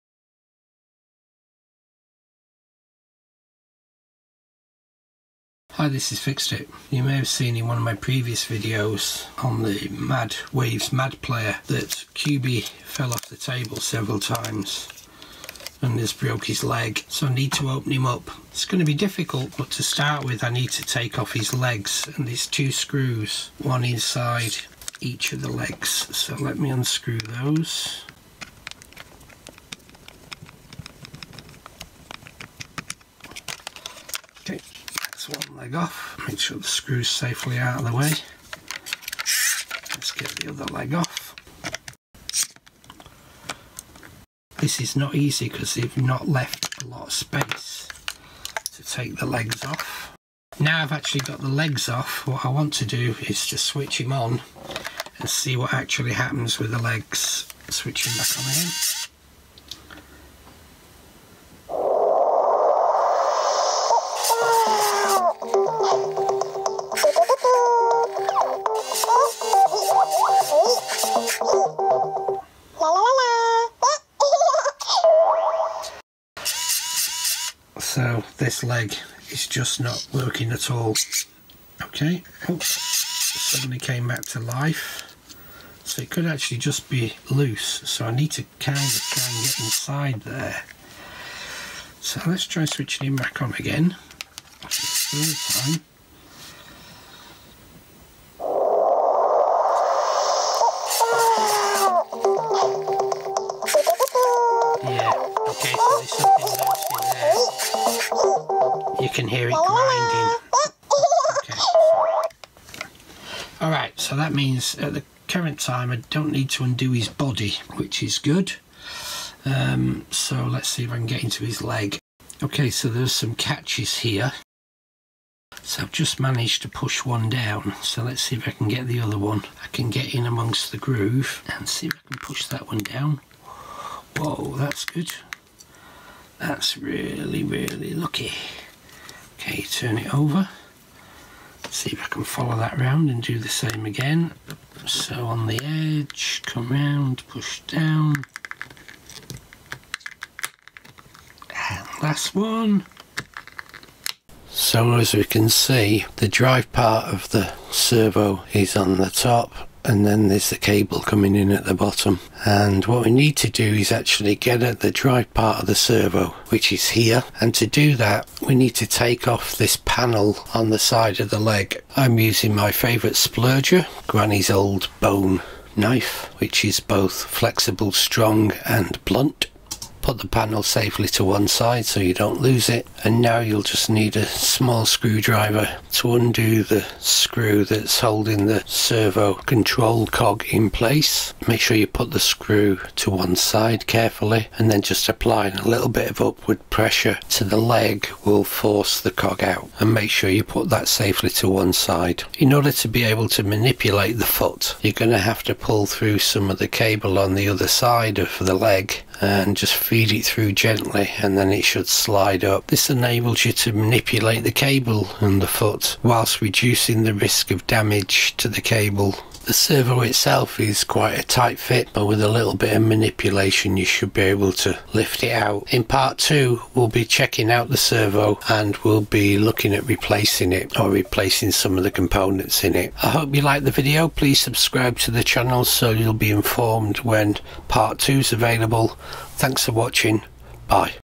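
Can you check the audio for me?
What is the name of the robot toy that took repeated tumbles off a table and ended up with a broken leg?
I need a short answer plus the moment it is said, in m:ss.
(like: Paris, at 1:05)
Cubee, at 0:12.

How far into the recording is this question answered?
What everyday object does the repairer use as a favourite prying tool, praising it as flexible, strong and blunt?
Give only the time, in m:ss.
2:54.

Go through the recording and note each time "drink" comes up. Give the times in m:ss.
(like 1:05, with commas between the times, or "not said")
not said.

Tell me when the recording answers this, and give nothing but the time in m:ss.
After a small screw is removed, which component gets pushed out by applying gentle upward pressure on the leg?
3:08.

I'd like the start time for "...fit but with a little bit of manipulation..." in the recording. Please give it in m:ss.
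3:41.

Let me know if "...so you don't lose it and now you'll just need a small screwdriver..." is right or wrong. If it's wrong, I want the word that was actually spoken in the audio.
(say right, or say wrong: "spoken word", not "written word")
right.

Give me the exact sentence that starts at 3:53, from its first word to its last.
I hope you liked the video please subscribe to the channel so you'll be informed when part two is available.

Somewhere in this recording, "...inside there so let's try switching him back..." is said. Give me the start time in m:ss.
1:29.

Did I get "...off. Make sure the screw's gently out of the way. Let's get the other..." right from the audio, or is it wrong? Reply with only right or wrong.
wrong.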